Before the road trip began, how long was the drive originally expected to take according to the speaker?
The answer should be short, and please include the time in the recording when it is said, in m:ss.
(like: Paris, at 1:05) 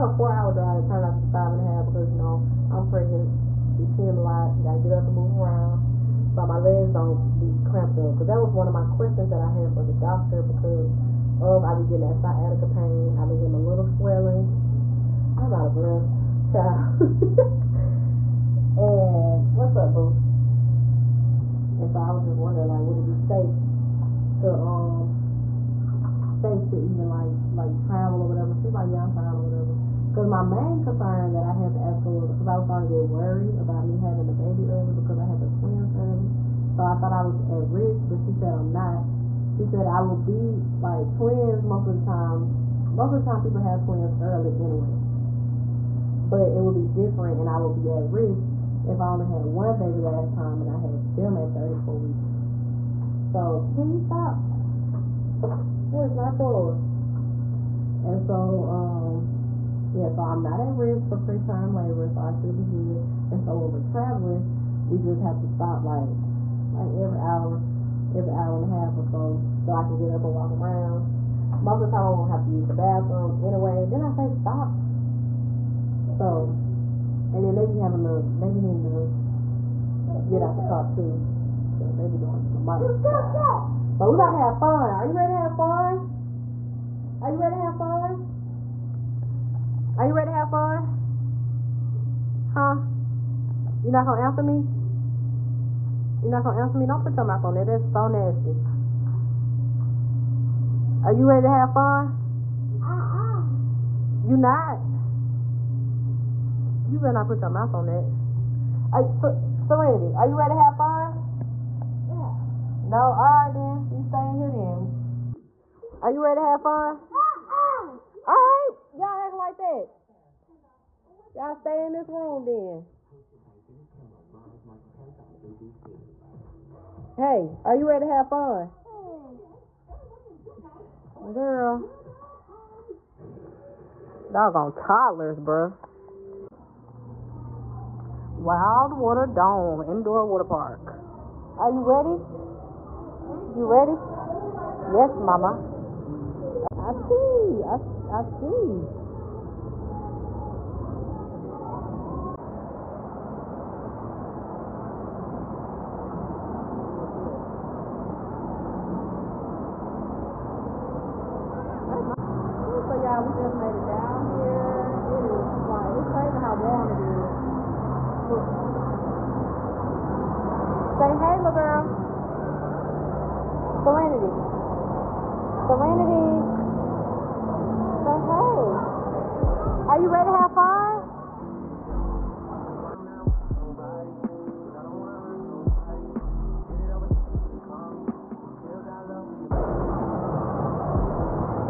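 4 hours, at 0:00.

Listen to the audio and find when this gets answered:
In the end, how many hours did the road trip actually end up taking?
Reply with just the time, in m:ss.
0:01.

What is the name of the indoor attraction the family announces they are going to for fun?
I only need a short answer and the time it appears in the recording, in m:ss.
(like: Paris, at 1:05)
Water Dome Indoor Water Park, at 2:18.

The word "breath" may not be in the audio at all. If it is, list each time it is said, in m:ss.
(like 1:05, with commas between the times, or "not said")
0:15.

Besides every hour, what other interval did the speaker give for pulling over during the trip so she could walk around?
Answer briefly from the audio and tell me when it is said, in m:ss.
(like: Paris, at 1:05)
hour and a half, at 1:08.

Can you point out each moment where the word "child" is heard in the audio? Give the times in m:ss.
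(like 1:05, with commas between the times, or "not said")
0:16.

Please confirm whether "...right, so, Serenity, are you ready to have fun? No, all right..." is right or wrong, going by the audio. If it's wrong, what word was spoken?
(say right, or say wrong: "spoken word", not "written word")
right.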